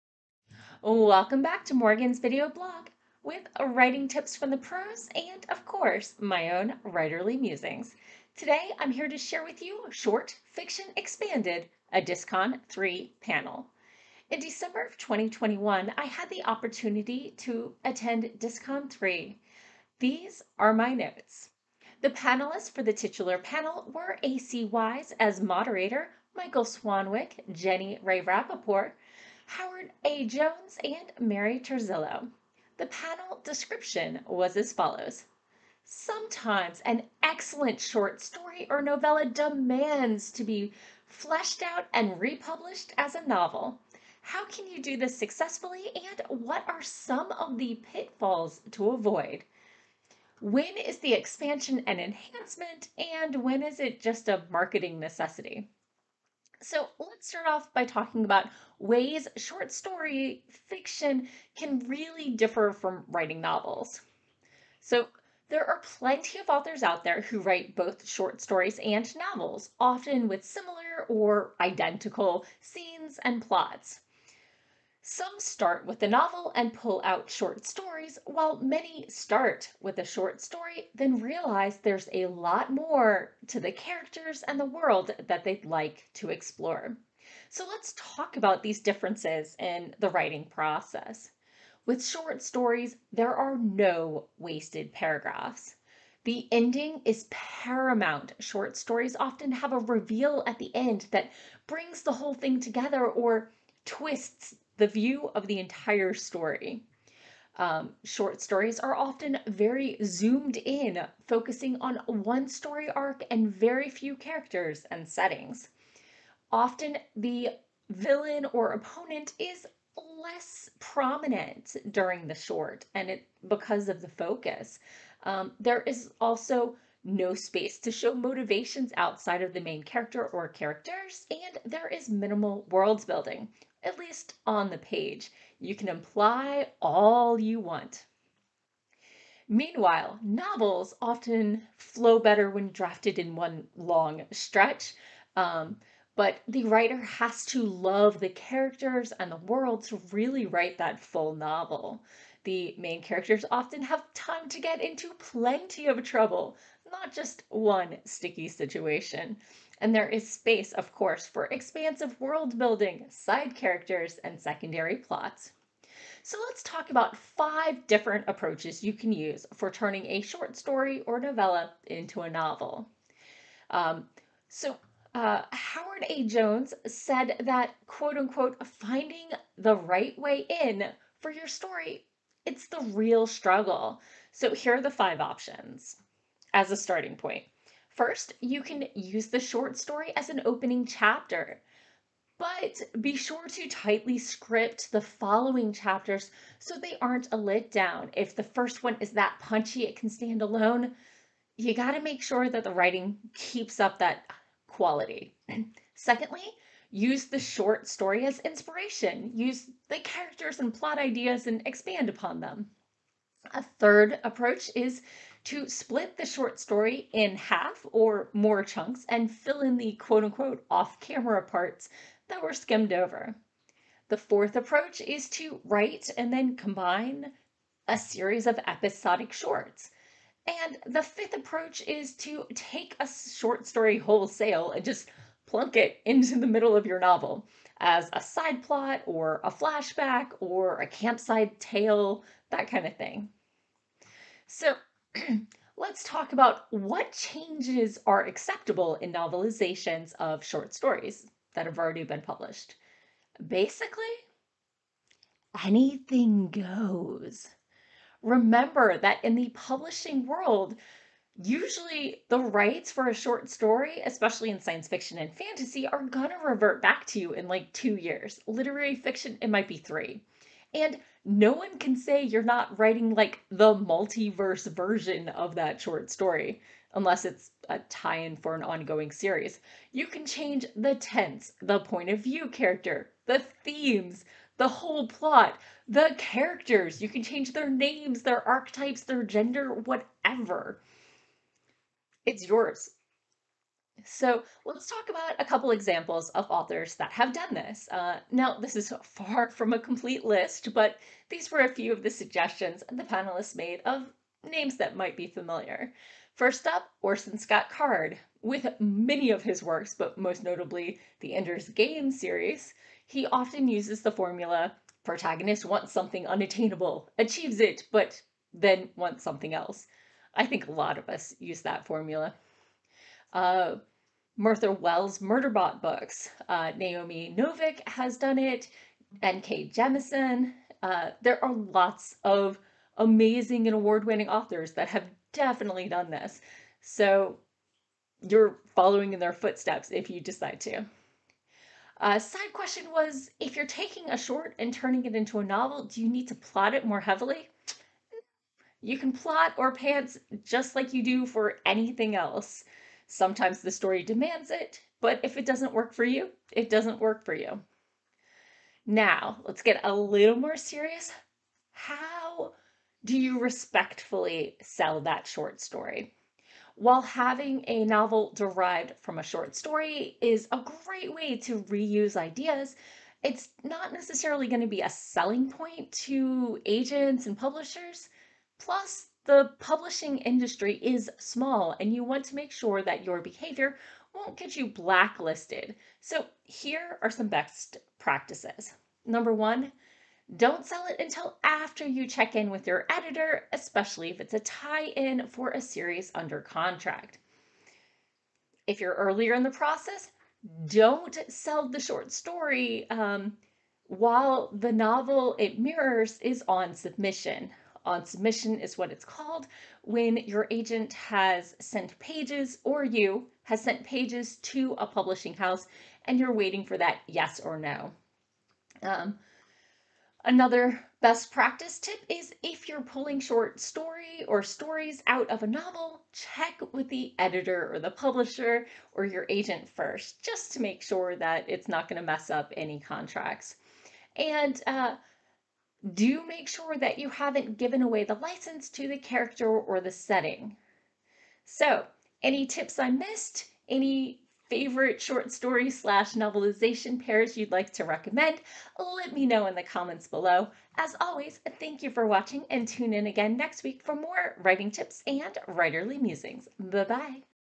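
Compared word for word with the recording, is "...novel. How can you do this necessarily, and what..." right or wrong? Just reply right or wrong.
wrong.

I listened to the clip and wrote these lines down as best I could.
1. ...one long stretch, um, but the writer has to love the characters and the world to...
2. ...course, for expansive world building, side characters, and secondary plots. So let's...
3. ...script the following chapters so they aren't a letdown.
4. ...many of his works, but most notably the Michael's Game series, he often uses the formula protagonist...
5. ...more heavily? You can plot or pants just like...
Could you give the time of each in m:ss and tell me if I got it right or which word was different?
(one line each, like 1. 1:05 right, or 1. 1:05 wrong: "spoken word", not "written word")
1. 2:23 right
2. 2:40 right
3. 3:14 right
4. 5:08 wrong: "Ender", not "Michael"
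5. 5:46 right.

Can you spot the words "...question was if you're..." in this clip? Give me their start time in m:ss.
5:42.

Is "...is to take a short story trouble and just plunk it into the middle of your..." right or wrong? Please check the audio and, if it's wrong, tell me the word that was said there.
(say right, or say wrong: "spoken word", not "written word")
wrong: "wholesale", not "trouble".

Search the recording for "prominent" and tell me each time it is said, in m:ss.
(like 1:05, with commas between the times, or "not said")
2:00.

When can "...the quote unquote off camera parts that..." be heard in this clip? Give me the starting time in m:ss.
3:39.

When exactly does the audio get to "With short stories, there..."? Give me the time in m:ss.
1:31.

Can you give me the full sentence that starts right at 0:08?
Today, I'm here to share with you Short Fiction Expanded, a DISCON 3 panel.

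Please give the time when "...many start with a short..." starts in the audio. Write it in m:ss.
1:18.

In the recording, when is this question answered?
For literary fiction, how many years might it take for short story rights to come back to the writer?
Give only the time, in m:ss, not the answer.
4:29.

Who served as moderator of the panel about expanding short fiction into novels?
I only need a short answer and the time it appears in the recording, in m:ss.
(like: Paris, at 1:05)
AC Wise, at 0:24.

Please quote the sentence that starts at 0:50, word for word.
When is the expansion an enhancement, and when is it just a marketing necessity?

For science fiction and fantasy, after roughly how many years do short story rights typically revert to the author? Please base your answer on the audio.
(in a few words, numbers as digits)
2 years.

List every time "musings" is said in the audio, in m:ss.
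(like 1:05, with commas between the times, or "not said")
0:07, 7:35.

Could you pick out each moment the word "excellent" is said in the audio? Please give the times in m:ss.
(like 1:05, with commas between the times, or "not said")
0:37.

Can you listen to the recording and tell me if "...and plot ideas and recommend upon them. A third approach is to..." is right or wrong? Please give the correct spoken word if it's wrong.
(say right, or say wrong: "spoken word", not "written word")
wrong: "expand", not "recommend".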